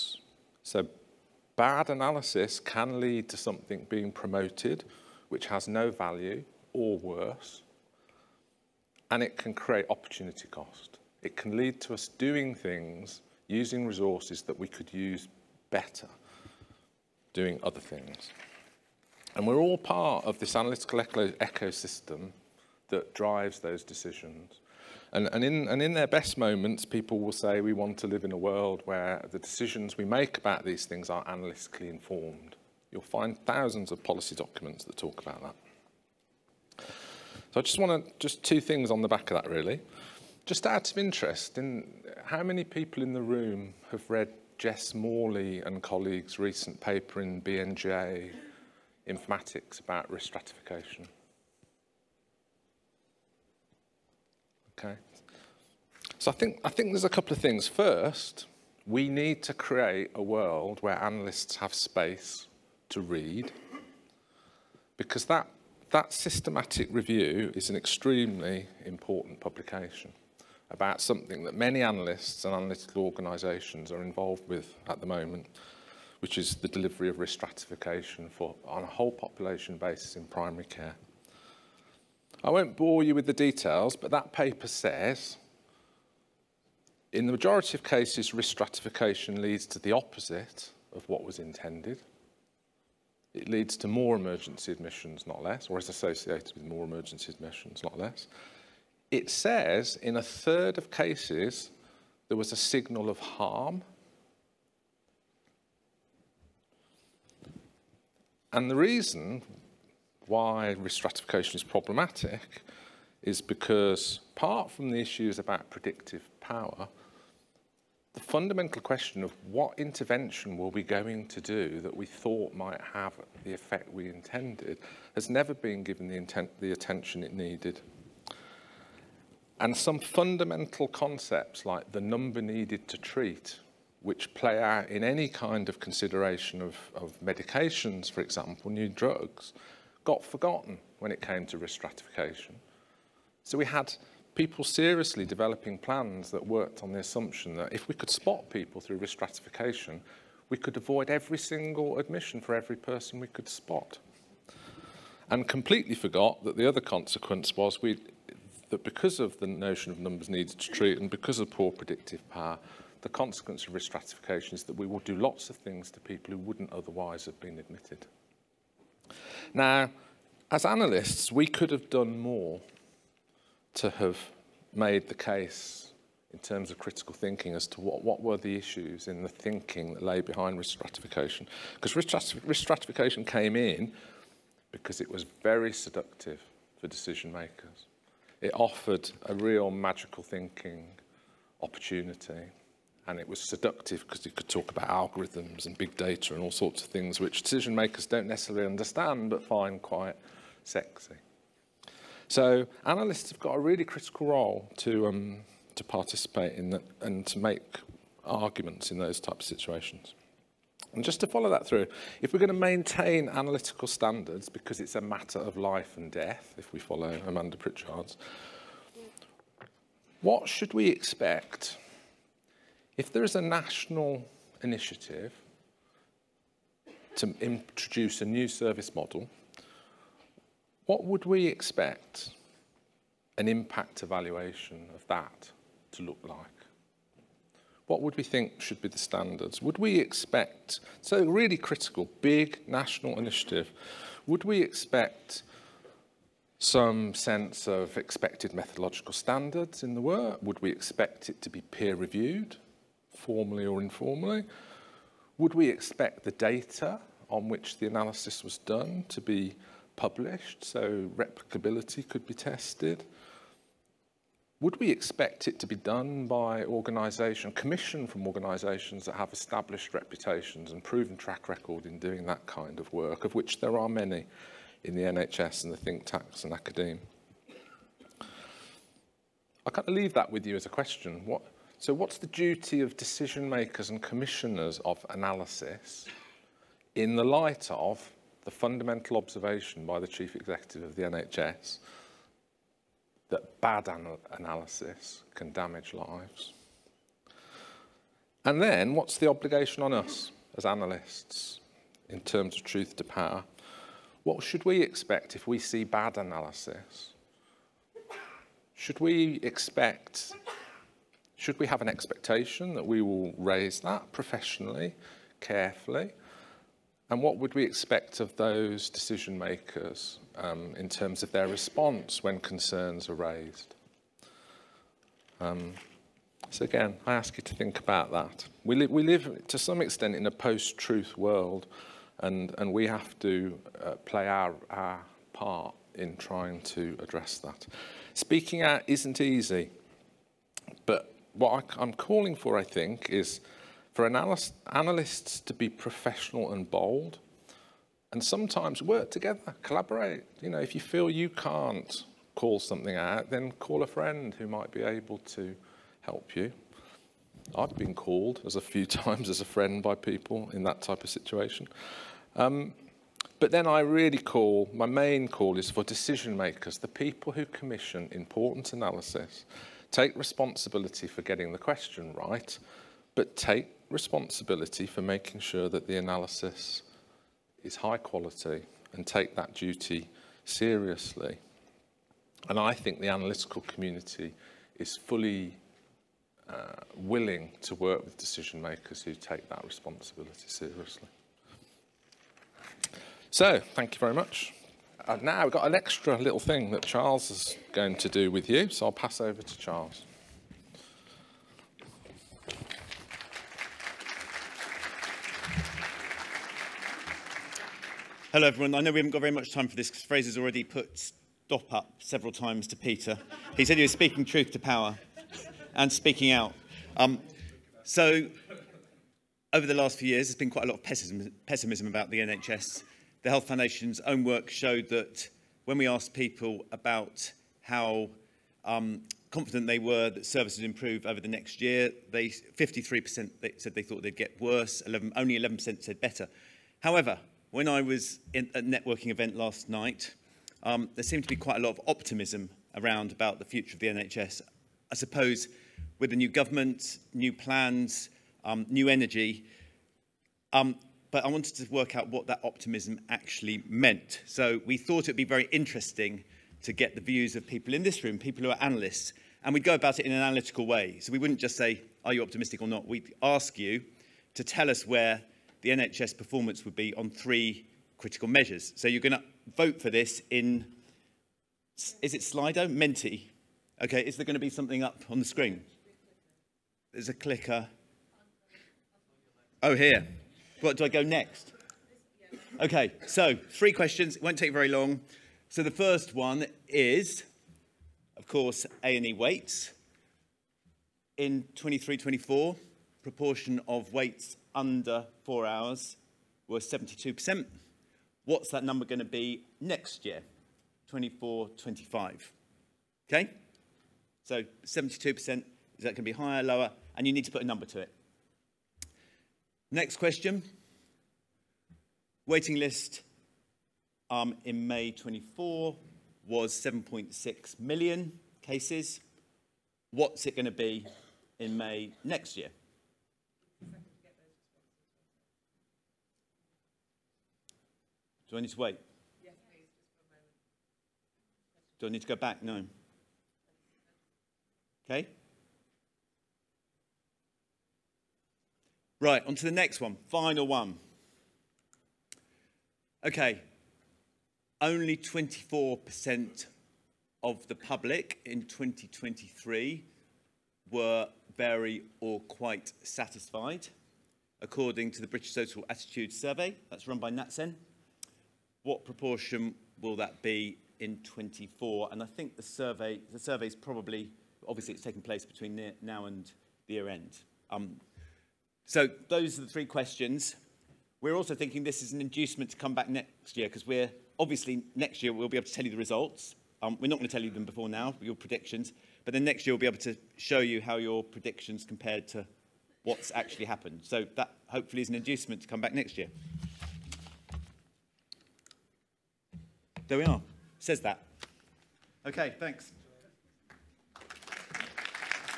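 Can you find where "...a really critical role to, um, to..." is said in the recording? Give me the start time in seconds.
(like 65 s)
203 s.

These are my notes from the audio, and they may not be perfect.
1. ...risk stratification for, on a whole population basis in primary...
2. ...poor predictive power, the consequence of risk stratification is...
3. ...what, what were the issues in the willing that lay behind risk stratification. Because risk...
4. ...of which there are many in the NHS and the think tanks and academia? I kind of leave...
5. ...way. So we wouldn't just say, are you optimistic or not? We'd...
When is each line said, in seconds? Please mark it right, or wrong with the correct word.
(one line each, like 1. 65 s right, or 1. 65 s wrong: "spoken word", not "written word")
1. 77 s right
2. 161 s right
3. 177 s wrong: "thinking", not "willing"
4. 273 s right
5. 460 s right.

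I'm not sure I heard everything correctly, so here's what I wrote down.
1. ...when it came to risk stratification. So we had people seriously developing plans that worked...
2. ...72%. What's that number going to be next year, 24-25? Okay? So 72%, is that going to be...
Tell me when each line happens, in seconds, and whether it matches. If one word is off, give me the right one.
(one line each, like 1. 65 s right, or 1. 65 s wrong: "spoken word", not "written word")
1. 140 s right
2. 496 s right.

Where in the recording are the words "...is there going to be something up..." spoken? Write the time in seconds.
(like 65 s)
474 s.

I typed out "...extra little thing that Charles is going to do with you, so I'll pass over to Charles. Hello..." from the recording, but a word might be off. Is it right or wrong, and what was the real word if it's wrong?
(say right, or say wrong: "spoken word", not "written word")
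right.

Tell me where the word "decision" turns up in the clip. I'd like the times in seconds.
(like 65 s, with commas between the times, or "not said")
23 s, 29 s, 186 s, 197 s, 282 s, 318 s, 365 s, 388 s.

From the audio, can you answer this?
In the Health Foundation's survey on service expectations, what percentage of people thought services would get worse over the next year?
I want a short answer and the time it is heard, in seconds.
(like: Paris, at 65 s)
53%, at 432 s.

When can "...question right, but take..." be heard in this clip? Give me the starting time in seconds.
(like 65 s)
371 s.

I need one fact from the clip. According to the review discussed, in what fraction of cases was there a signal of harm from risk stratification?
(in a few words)
a third.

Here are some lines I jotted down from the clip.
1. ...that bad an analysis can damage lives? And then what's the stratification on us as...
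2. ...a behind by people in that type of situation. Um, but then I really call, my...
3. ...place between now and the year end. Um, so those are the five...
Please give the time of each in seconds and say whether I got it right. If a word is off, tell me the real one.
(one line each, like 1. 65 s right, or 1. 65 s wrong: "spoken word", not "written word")
1. 293 s wrong: "obligation", not "stratification"
2. 359 s wrong: "friend", not "behind"
3. 565 s wrong: "three", not "five".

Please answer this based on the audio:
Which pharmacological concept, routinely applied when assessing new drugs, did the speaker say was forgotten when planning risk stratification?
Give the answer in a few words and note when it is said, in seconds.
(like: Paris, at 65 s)
number needed to treat, at 132 s.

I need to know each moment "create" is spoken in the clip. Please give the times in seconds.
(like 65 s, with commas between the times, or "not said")
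9 s, 59 s.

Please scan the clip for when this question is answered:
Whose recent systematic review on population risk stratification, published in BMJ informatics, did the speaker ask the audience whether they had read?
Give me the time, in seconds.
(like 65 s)
44 s.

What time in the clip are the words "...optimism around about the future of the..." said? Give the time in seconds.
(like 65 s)
441 s.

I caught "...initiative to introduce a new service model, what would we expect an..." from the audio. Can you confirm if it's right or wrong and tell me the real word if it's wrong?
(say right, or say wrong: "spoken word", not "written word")
right.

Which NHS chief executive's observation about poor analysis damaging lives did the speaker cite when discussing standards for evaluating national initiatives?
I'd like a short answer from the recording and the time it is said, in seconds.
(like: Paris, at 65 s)
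Amanda Pritchard, at 217 s.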